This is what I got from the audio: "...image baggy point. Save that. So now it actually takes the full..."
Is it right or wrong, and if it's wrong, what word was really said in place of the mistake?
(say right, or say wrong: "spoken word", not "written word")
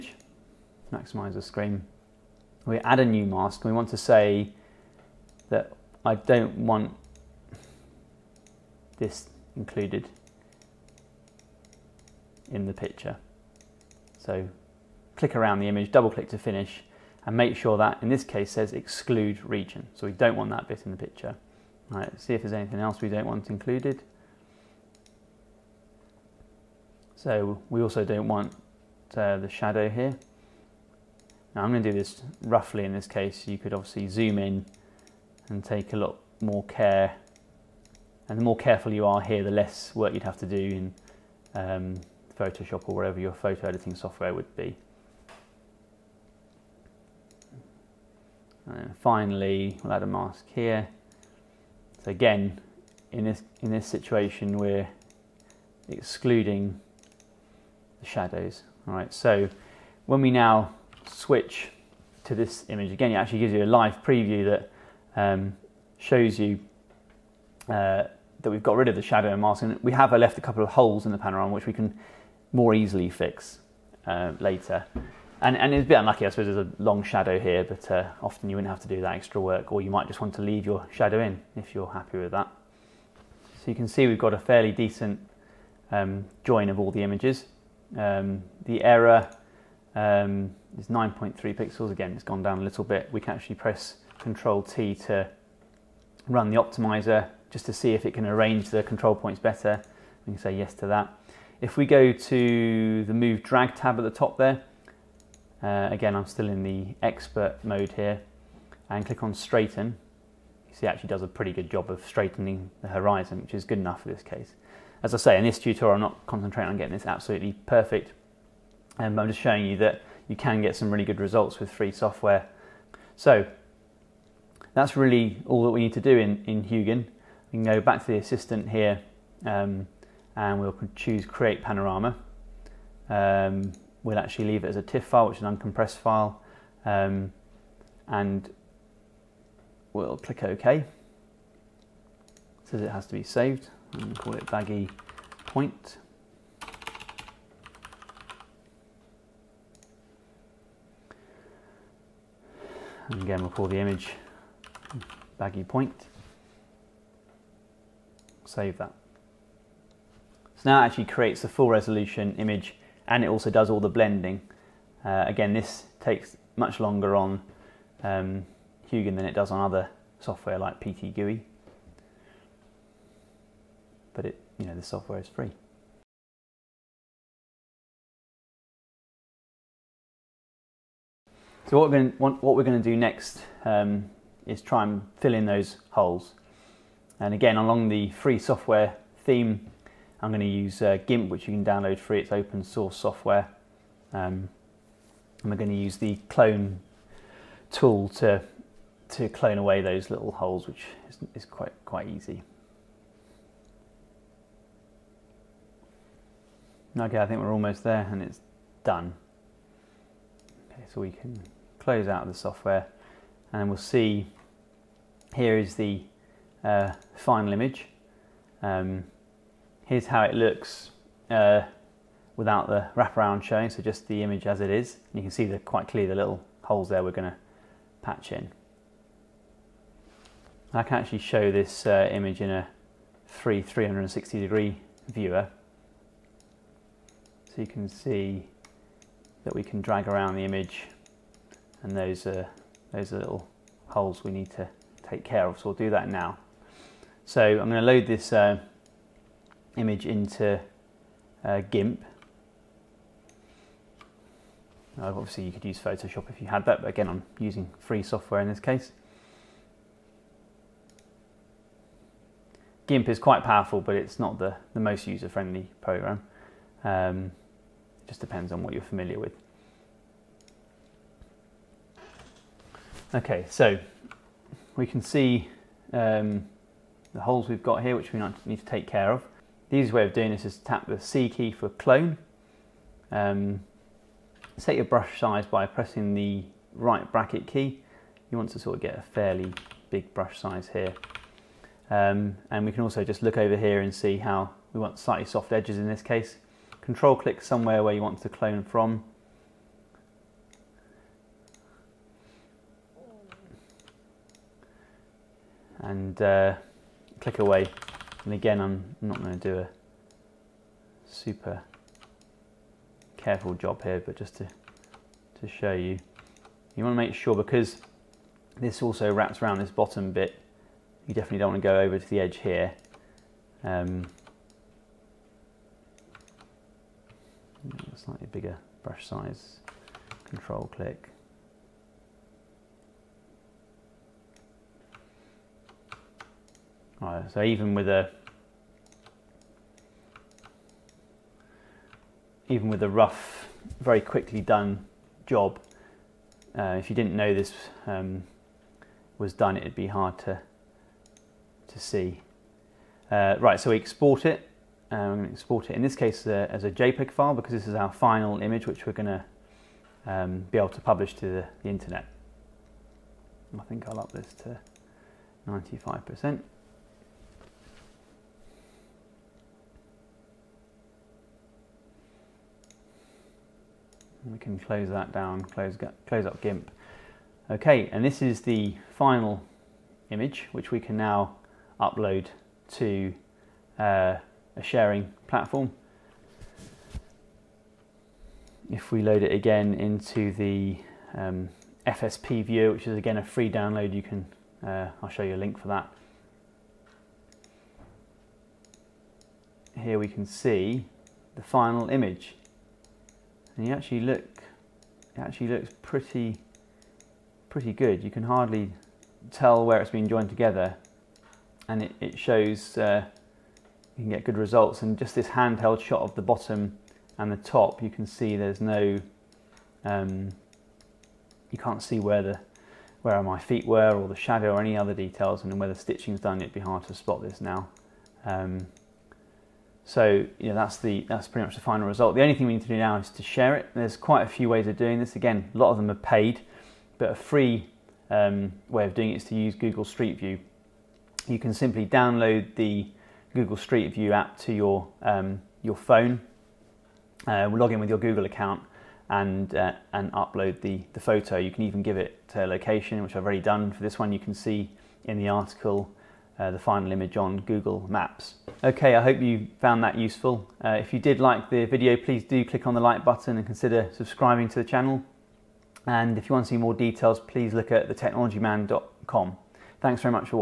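wrong: "creates", not "takes".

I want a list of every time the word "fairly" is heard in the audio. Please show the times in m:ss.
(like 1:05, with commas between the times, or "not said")
1:24, 4:49.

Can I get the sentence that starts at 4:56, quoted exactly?
Control click somewhere where you want to clone from.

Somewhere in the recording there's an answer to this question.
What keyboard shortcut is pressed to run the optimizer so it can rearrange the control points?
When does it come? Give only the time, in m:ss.
1:34.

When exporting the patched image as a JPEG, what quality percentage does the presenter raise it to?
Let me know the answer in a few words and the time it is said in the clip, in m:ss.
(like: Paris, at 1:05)
95%, at 6:05.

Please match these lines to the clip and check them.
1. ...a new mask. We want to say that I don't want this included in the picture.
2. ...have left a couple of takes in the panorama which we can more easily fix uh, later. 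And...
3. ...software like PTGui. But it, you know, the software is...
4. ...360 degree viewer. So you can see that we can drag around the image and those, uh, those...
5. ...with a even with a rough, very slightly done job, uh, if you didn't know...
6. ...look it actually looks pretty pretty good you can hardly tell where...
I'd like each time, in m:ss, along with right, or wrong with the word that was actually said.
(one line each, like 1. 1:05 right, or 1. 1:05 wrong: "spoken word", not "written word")
1. 0:02 right
2. 1:09 wrong: "holes", not "takes"
3. 2:50 right
4. 3:53 right
5. 5:37 wrong: "quickly", not "slightly"
6. 6:44 right.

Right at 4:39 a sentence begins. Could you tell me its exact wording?
The easiest way of doing this is to tap the C key for clone.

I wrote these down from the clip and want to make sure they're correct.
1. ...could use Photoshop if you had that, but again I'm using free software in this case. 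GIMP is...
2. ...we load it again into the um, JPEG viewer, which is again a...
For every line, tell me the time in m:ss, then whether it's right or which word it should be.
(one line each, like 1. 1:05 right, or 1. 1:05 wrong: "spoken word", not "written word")
1. 4:15 right
2. 6:28 wrong: "FSP", not "JPEG".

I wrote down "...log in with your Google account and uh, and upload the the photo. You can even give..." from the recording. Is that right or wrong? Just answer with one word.
right.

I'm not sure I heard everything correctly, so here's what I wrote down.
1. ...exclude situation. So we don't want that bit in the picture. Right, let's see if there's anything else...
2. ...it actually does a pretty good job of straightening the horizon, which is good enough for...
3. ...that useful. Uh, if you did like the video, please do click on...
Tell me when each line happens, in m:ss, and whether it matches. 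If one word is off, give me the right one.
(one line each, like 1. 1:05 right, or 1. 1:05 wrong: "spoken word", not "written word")
1. 0:18 wrong: "region", not "situation"
2. 1:50 right
3. 7:39 right.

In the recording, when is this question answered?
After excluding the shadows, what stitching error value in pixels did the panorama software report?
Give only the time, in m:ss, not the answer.
1:30.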